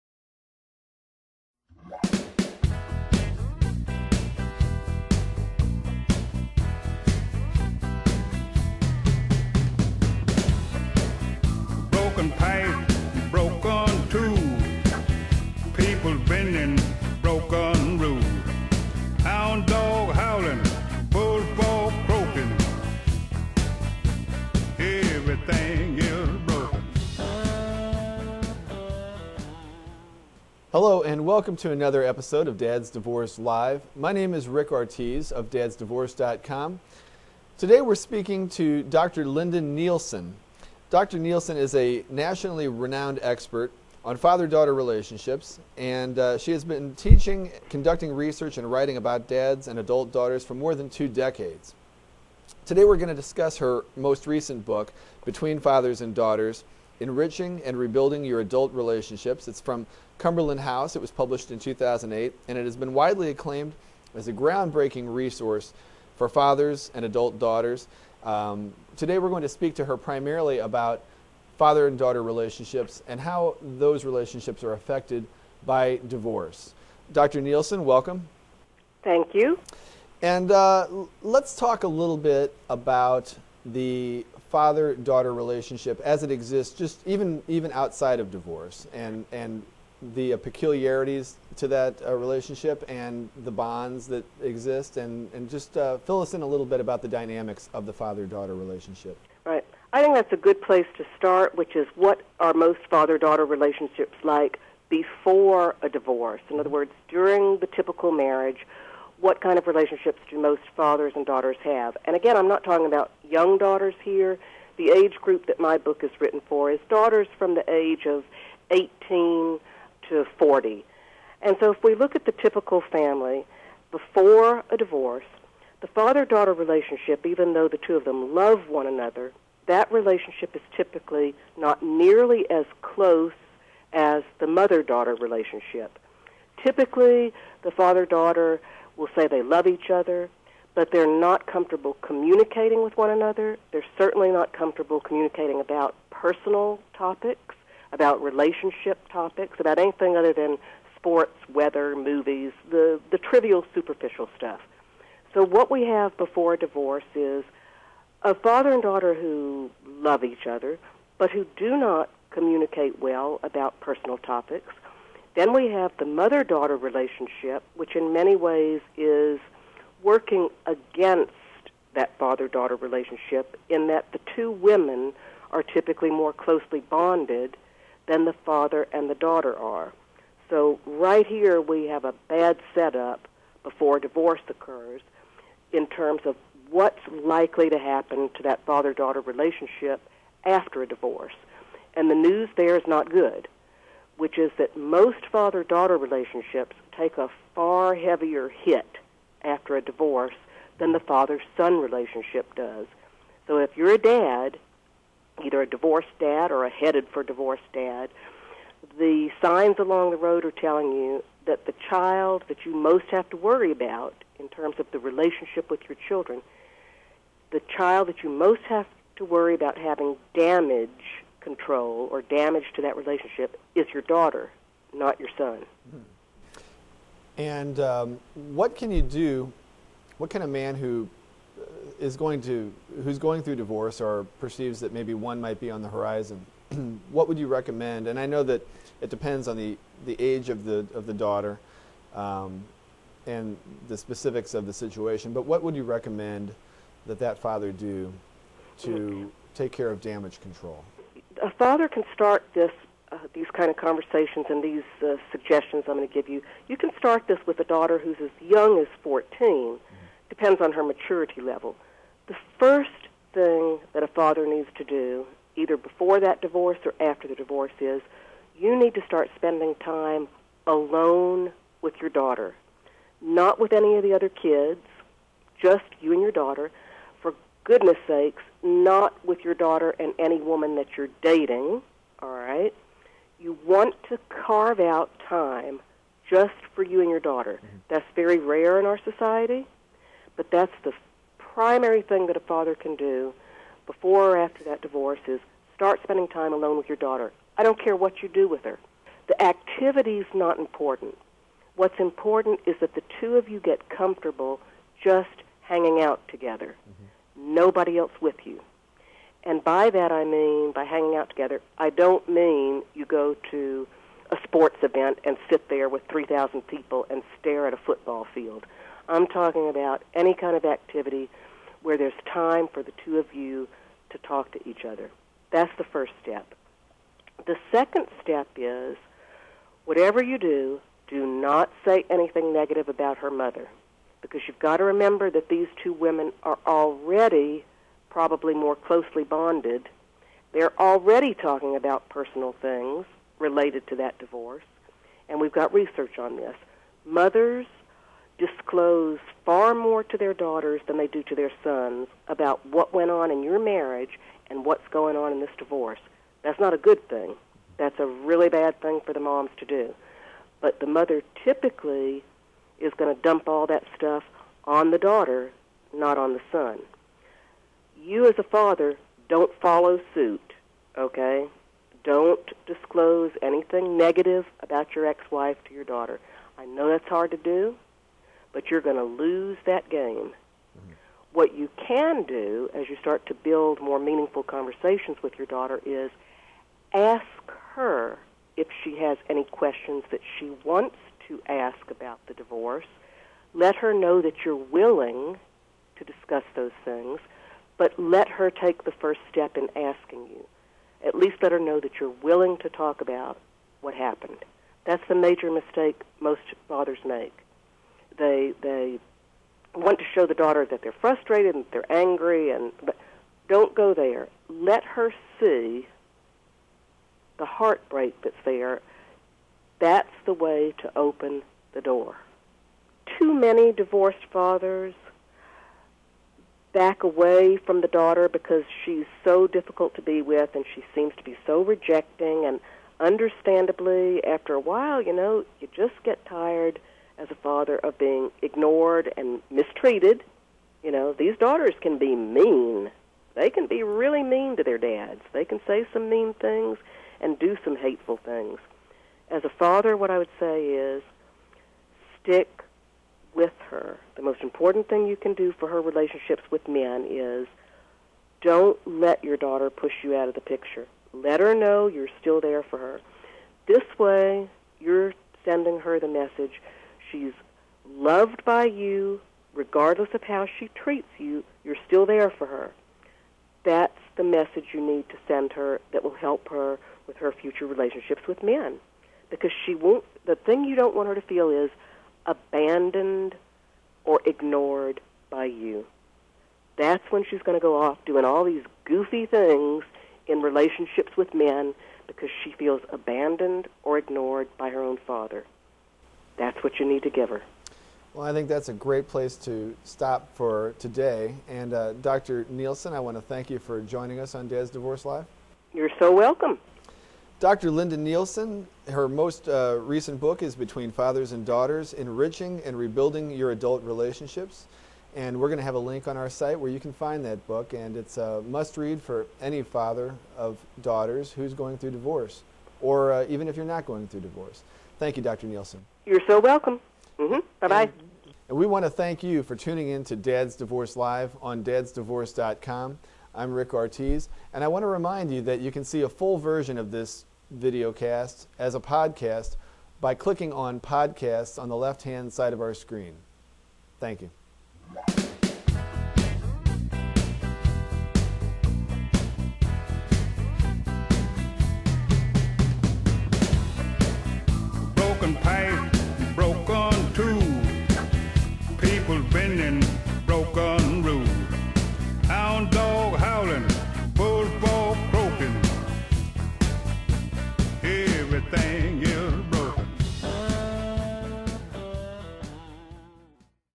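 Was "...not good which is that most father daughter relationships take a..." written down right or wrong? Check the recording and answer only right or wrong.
right.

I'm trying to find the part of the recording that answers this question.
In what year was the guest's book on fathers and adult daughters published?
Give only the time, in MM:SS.
01:01.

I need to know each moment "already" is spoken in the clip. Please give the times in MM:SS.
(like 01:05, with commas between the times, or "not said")
05:36, 05:40.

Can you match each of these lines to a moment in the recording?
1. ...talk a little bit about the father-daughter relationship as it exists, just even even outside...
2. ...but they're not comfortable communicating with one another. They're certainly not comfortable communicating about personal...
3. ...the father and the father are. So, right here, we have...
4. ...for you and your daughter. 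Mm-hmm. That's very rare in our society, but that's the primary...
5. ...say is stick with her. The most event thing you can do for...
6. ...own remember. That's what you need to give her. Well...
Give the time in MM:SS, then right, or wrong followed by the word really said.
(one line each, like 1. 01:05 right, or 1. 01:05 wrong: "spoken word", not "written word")
1. 01:21 right
2. 02:20 right
3. 02:58 wrong: "daughter", not "father"
4. 04:46 right
5. 07:30 wrong: "important", not "event"
6. 08:14 wrong: "father", not "remember".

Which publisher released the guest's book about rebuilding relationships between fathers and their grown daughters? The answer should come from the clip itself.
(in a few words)
Cumberland House.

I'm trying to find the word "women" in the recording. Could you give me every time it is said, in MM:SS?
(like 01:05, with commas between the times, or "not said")
02:54, 05:35.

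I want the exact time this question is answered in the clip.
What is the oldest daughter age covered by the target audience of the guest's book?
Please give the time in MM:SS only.
02:00.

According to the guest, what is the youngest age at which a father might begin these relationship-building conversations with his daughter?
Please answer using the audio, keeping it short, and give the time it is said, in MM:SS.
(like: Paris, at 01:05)
14, at 04:19.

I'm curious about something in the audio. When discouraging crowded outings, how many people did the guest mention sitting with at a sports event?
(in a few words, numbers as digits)
3,000.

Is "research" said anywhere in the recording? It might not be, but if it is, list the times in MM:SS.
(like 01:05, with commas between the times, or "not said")
00:48, 05:45.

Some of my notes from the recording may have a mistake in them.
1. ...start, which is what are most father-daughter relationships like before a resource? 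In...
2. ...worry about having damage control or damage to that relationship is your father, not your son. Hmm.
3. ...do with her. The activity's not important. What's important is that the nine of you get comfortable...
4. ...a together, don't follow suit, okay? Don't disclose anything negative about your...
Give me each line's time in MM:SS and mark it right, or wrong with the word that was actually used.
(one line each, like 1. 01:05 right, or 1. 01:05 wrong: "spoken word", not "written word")
1. 01:41 wrong: "divorce", not "resource"
2. 03:39 wrong: "daughter", not "father"
3. 04:58 wrong: "two", not "nine"
4. 06:08 wrong: "father", not "together".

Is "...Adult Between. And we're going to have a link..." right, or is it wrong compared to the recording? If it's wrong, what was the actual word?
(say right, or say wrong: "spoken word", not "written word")
wrong: "Relationships", not "Between".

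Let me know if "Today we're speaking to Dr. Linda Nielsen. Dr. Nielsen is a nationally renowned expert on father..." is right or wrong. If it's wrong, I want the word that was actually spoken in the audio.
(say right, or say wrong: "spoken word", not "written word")
right.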